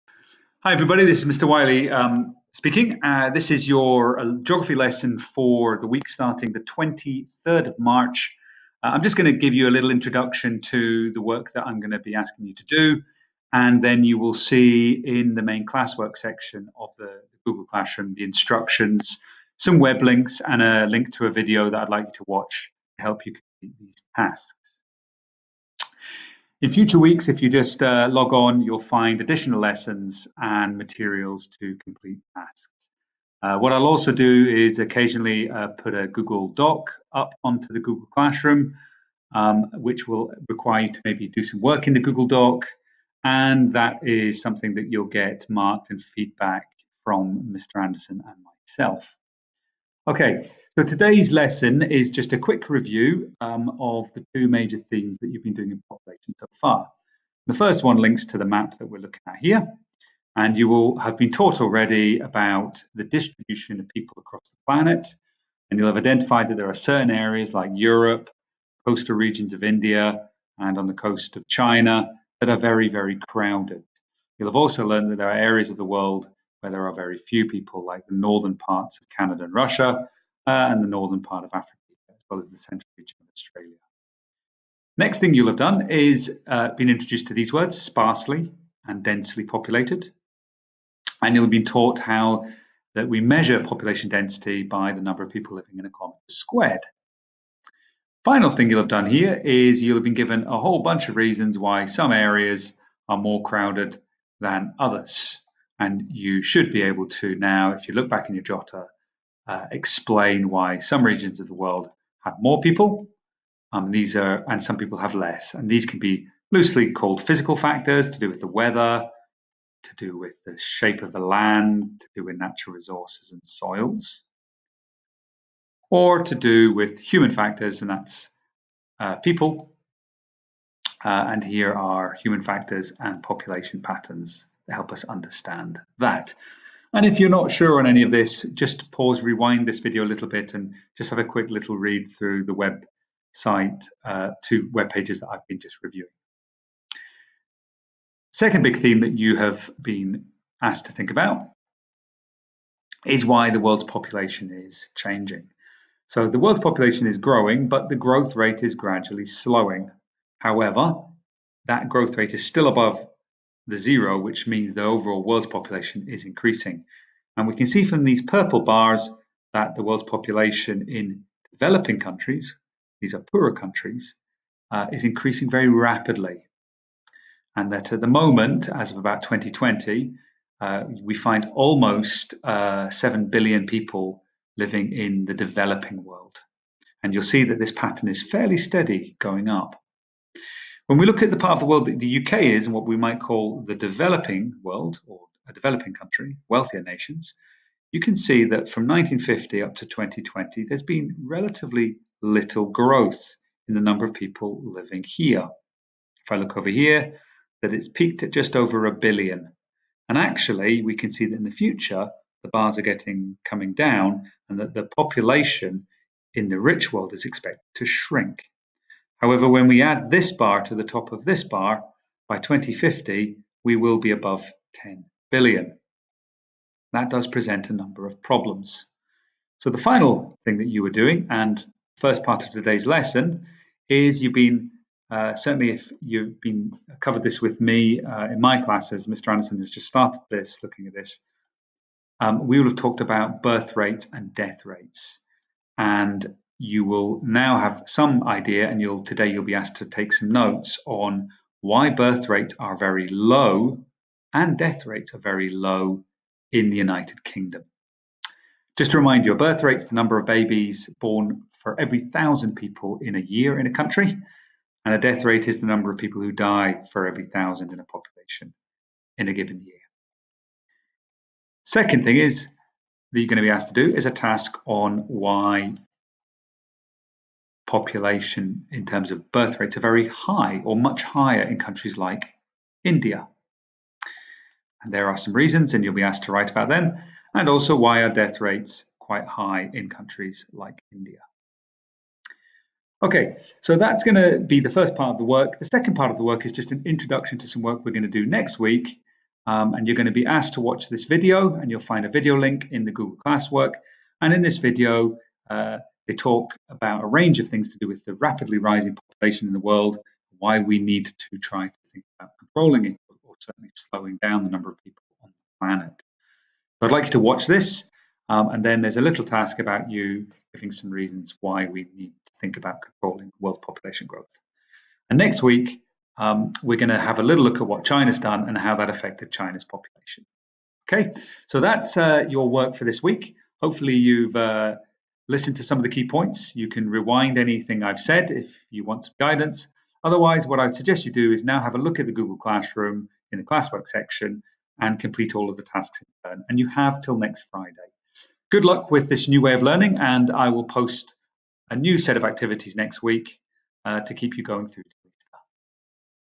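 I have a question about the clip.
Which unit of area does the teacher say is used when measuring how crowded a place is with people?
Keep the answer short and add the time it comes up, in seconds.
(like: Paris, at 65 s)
kilometre squared, at 95 s.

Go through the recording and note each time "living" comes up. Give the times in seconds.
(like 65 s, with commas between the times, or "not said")
95 s, 184 s, 204 s.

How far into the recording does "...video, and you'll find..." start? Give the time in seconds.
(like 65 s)
301 s.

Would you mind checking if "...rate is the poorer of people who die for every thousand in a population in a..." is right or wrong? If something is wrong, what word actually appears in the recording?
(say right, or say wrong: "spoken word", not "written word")
wrong: "number", not "poorer".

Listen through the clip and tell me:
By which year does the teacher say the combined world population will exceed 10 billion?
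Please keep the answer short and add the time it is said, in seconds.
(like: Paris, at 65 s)
2050, at 222 s.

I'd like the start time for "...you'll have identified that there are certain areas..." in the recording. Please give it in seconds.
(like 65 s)
65 s.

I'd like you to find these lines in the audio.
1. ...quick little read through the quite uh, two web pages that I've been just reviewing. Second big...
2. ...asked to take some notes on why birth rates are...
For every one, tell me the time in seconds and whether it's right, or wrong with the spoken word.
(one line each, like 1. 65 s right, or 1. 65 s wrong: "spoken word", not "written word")
1. 141 s wrong: "website", not "quite"
2. 249 s right.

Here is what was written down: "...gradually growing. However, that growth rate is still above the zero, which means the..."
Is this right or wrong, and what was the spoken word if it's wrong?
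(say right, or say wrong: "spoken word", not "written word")
wrong: "slowing", not "growing".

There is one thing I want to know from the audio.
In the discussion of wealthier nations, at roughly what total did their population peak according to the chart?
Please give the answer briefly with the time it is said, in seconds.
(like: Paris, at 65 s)
just over a billion, at 208 s.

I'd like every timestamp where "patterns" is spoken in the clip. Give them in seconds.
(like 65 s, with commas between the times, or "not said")
133 s, 187 s.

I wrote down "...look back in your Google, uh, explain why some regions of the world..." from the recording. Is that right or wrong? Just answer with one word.
wrong.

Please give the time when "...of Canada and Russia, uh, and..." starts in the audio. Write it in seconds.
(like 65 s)
79 s.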